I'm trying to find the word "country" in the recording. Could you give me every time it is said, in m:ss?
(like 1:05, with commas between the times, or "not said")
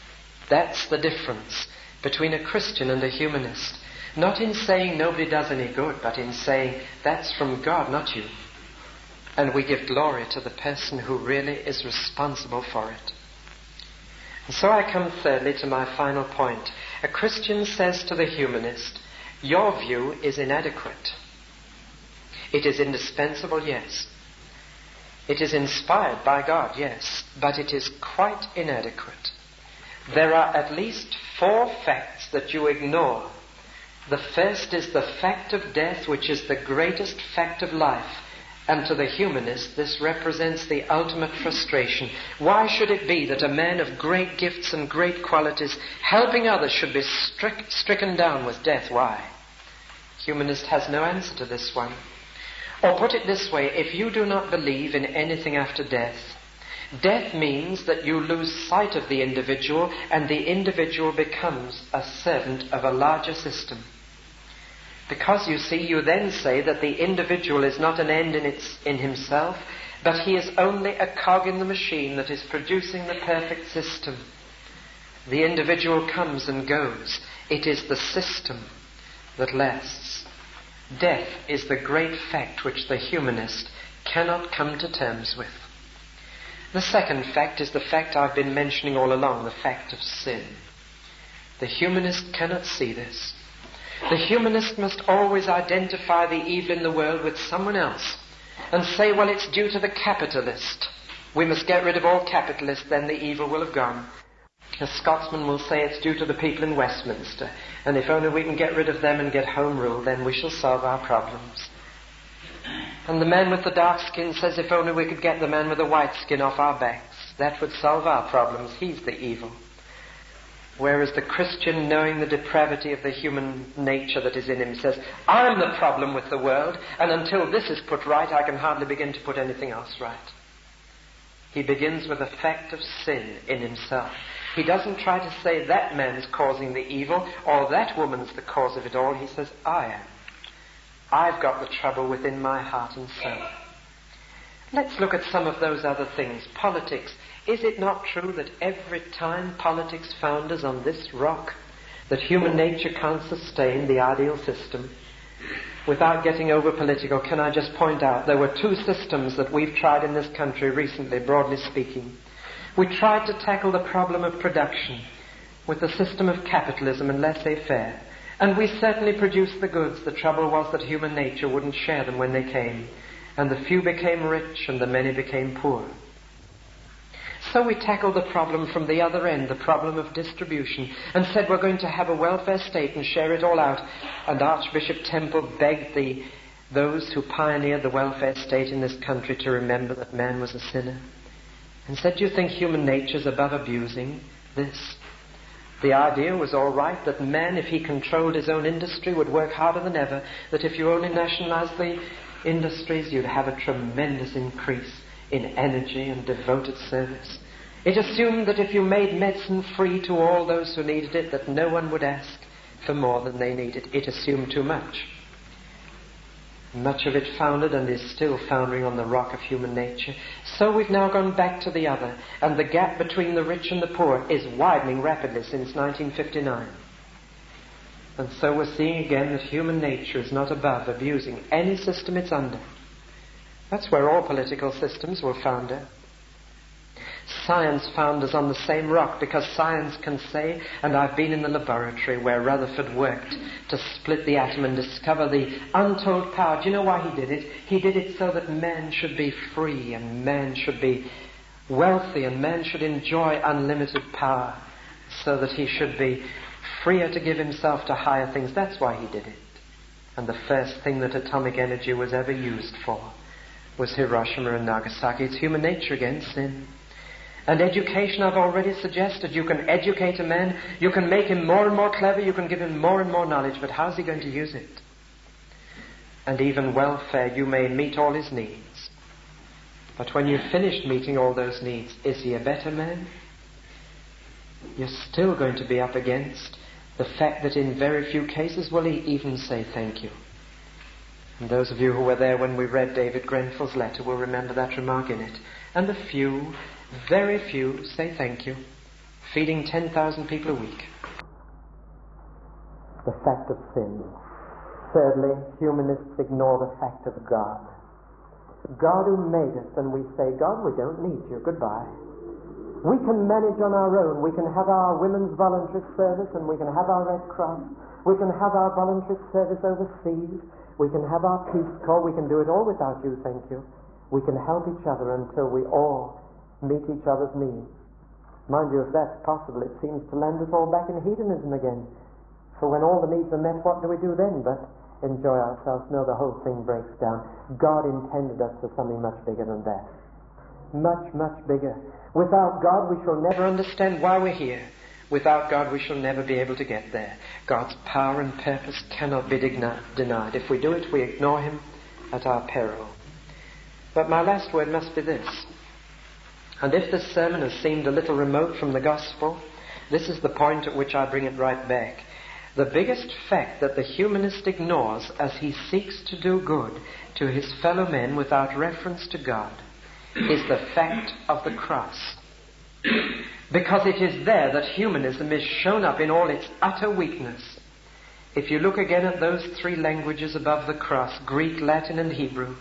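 2:40, 3:09.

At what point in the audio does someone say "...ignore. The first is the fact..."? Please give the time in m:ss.
0:32.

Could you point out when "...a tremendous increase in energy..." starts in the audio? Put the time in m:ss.
3:23.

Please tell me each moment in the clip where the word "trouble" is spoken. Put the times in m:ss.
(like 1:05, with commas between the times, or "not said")
2:21, 2:50.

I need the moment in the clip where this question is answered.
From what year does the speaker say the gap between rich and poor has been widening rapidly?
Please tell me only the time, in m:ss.
3:45.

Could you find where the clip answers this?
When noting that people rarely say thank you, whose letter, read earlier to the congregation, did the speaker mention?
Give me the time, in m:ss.
4:52.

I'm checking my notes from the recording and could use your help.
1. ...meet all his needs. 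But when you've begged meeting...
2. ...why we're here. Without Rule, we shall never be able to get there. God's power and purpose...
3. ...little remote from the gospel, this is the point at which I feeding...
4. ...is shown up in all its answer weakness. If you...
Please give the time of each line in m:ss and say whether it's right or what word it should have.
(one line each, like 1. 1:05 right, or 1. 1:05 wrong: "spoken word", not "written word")
1. 4:37 wrong: "finished", not "begged"
2. 5:44 wrong: "God", not "Rule"
3. 5:57 wrong: "bring", not "feeding"
4. 6:15 wrong: "utter", not "answer".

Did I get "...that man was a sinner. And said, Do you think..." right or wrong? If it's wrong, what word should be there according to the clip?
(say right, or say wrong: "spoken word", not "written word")
right.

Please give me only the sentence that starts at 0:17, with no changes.
A Christian says to the humanist, Your view is inadequate.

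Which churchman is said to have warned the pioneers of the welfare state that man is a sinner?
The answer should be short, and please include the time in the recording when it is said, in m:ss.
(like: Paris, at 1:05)
Archbishop Temple, at 3:04.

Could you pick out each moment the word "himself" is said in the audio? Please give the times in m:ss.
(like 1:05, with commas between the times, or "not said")
1:08, 2:13, 4:17.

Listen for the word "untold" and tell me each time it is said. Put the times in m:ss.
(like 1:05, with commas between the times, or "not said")
4:05.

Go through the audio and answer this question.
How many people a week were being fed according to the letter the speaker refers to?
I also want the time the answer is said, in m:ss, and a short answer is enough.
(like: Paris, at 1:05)
10,000, at 4:59.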